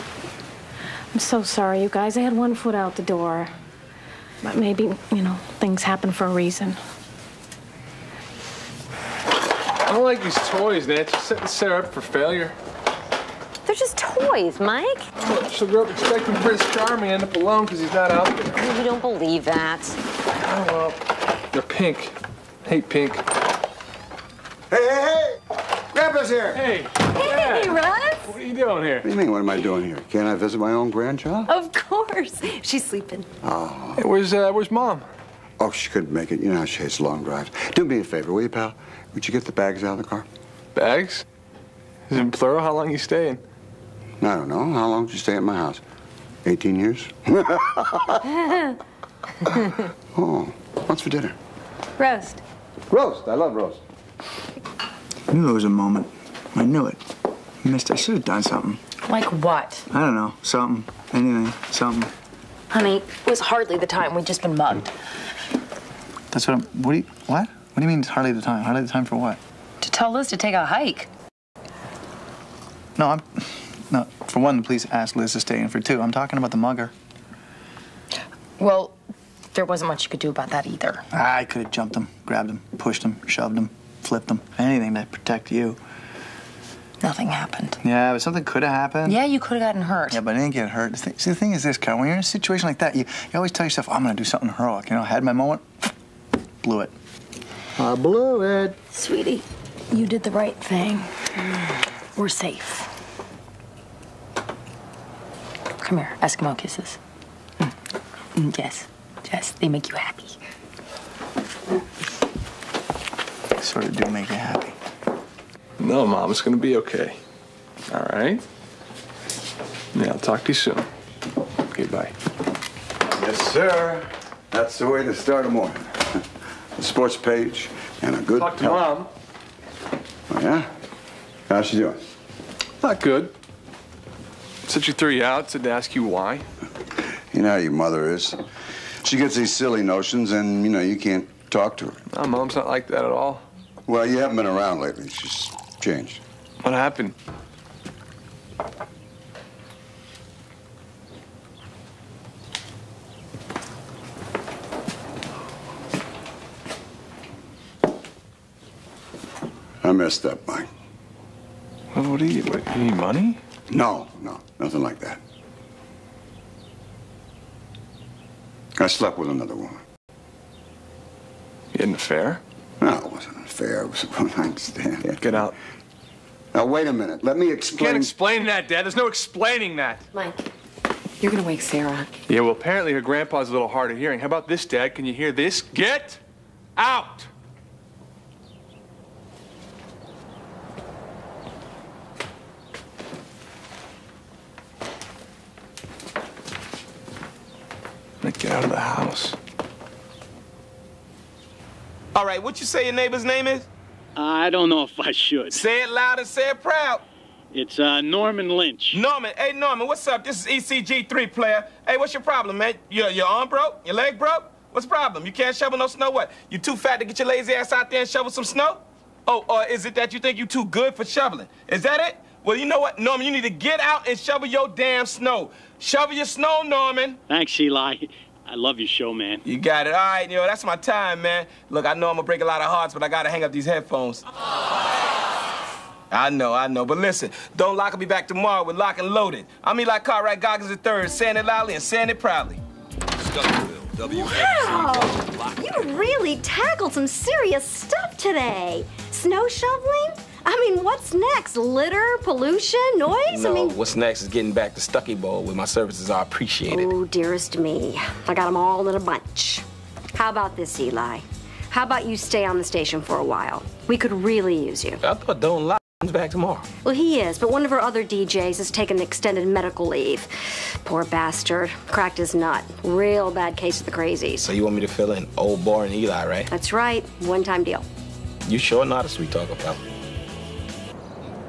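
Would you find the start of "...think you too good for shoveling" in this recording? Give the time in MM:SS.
03:40.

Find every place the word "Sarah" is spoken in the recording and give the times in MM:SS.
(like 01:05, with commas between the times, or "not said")
00:11, 03:01.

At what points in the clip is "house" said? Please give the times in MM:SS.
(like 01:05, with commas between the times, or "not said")
00:45, 03:18.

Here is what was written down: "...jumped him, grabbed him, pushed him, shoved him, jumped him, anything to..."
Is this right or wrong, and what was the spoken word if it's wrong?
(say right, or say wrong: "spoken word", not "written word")
wrong: "flipped", not "jumped".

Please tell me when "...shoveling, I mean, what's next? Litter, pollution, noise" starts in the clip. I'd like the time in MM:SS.
04:09.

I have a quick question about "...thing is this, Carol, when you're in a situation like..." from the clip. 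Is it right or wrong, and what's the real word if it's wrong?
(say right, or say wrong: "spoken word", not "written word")
right.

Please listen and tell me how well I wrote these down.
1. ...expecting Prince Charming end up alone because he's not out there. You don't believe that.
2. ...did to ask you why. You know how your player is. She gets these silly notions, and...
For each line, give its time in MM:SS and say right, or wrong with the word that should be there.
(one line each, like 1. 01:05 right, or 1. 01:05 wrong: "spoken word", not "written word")
1. 00:15 right
2. 02:15 wrong: "mother", not "player".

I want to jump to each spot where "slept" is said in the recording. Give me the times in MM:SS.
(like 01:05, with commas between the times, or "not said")
02:48.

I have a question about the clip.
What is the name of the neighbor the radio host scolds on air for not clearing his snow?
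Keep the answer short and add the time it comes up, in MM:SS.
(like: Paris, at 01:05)
Norman Lynch, at 03:28.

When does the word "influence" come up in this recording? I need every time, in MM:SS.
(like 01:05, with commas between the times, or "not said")
not said.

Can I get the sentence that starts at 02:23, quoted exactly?
Well, you haven't been around lately.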